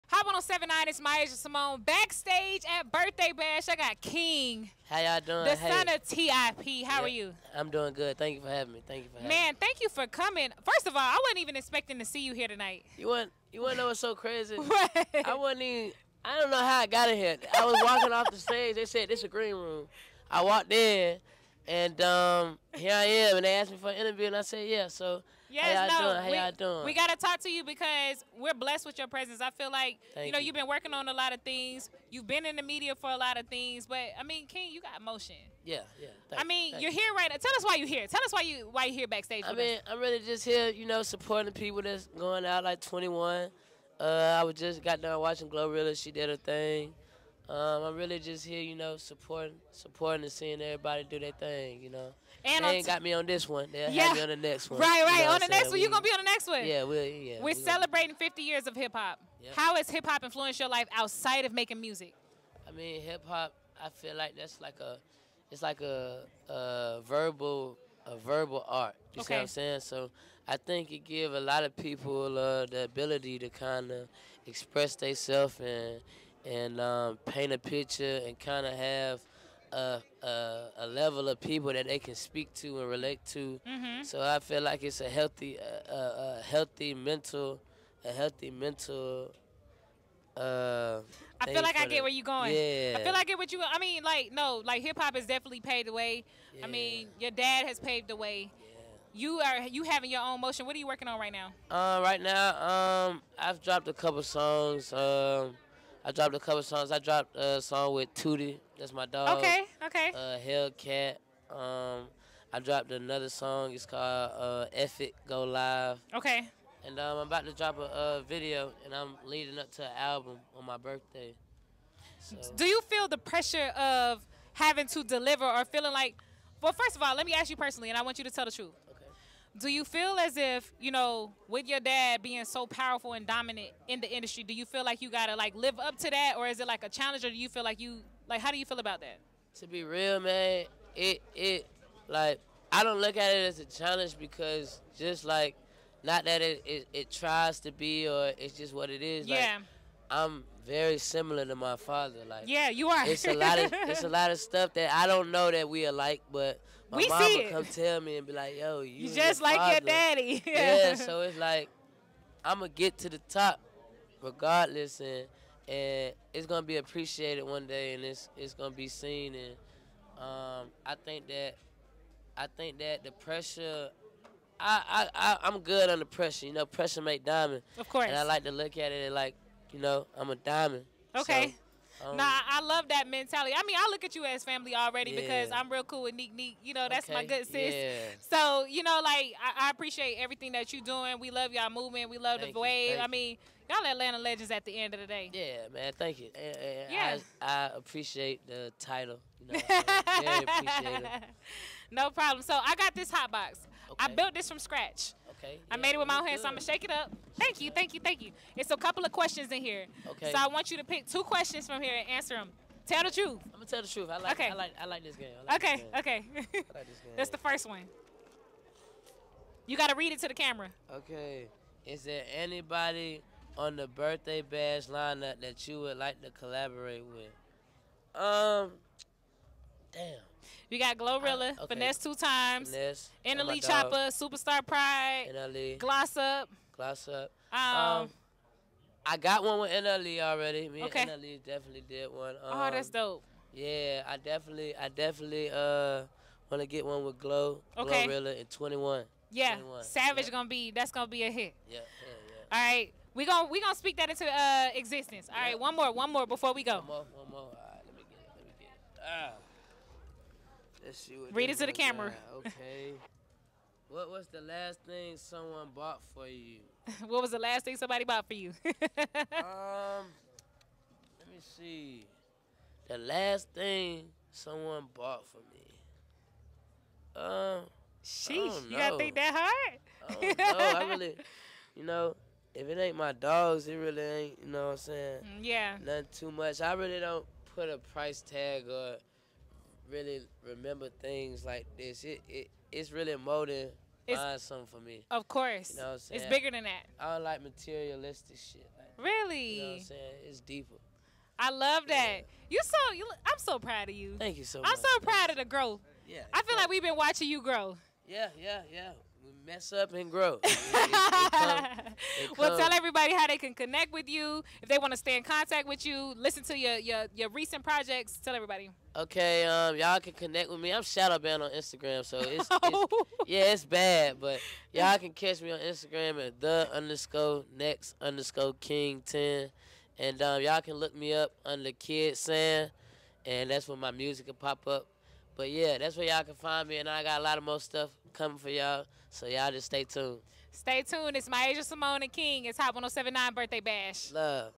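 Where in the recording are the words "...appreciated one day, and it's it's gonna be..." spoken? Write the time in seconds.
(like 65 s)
166 s.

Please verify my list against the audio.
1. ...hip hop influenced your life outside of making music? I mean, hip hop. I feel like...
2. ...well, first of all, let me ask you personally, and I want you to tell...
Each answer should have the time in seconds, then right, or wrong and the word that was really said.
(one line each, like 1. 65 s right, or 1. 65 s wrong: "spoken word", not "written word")
1. 59 s right
2. 126 s right.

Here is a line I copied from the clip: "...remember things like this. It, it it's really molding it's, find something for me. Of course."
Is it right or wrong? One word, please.
right.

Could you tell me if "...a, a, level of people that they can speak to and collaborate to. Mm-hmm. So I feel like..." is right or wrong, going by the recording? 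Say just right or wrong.
wrong.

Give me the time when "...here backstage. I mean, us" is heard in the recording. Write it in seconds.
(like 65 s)
38 s.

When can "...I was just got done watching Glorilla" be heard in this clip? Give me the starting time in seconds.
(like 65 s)
44 s.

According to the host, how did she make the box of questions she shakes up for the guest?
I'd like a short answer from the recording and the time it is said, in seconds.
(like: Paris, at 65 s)
from scratch, at 204 s.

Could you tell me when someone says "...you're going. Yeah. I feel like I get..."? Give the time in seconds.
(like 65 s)
92 s.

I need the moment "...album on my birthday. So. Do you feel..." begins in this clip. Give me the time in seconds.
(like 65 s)
119 s.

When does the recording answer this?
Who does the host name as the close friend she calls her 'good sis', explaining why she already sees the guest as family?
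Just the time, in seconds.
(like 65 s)
186 s.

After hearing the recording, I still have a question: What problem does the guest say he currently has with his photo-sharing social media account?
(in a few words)
shadow banned.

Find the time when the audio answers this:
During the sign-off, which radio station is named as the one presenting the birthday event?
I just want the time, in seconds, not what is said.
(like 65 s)
342 s.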